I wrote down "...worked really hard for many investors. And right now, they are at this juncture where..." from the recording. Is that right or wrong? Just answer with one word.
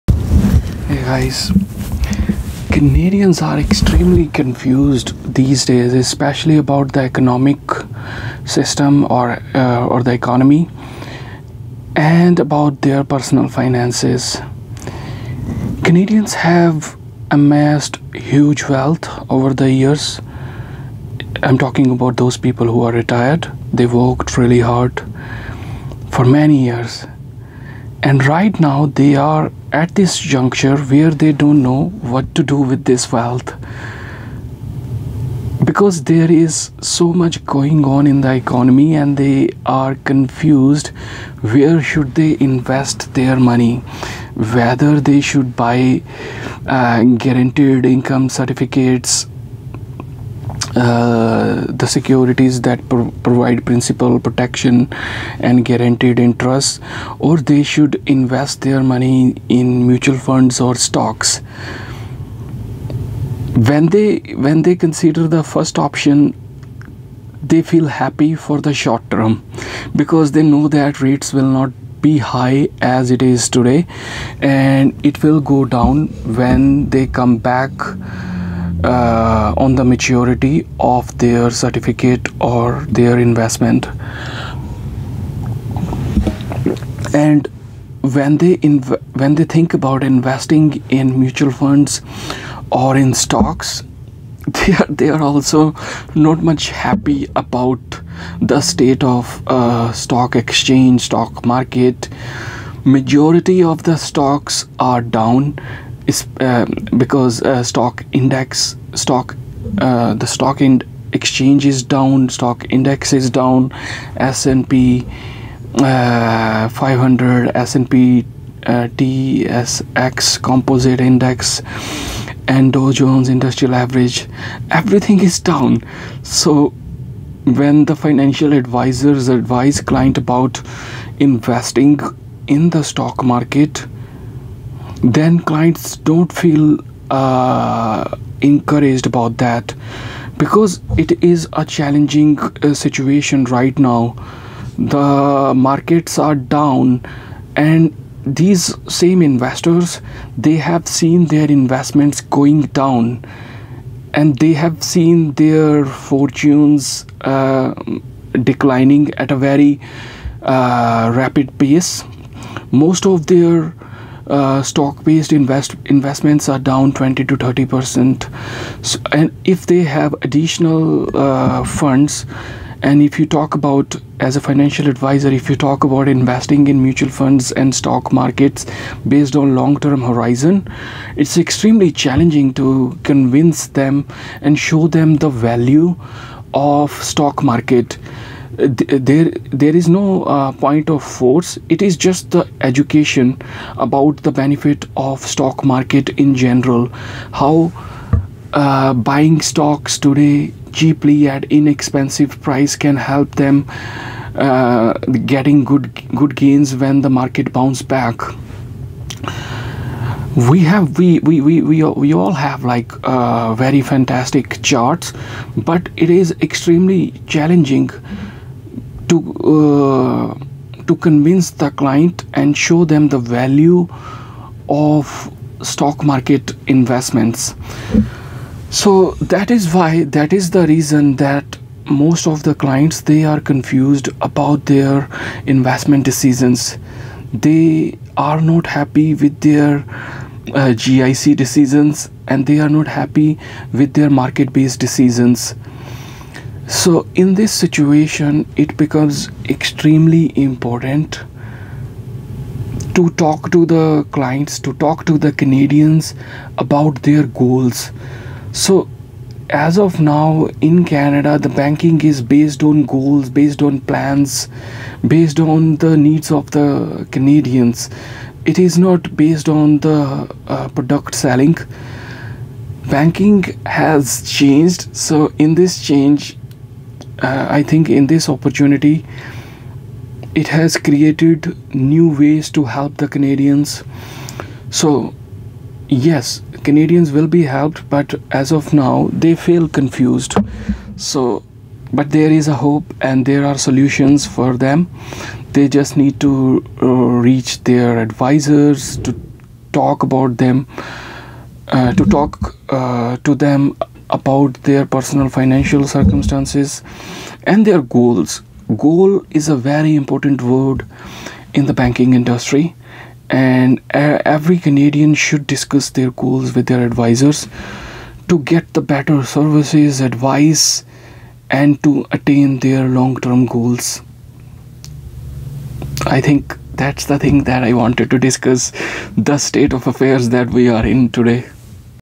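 wrong.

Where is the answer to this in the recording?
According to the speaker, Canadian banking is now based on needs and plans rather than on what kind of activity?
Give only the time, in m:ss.
4:30.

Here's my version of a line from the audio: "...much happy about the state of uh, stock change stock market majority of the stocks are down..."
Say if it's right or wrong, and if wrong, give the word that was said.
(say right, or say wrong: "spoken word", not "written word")
wrong: "exchange", not "change".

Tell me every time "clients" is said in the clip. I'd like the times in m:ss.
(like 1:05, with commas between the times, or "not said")
2:09, 2:15, 3:41, 3:52, 4:14.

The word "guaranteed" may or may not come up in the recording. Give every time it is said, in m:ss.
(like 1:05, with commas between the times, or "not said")
0:47, 0:55.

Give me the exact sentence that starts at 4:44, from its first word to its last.
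So, yes, Canadians will be helped, but as of now, they feel confused.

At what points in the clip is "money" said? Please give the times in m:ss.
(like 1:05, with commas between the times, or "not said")
0:43, 0:58.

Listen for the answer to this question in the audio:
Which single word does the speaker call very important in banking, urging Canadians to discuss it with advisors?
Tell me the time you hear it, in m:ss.
5:08.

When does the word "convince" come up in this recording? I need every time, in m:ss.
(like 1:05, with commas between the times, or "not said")
3:03, 3:41.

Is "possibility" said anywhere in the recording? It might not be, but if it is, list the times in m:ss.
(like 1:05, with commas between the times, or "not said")
not said.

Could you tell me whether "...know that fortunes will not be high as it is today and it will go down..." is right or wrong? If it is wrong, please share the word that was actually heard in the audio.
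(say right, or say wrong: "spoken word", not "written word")
wrong: "rates", not "fortunes".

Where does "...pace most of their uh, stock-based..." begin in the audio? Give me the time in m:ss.
2:41.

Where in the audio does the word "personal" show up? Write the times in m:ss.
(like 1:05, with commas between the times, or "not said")
0:13, 5:04.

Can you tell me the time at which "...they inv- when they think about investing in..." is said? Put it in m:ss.
1:28.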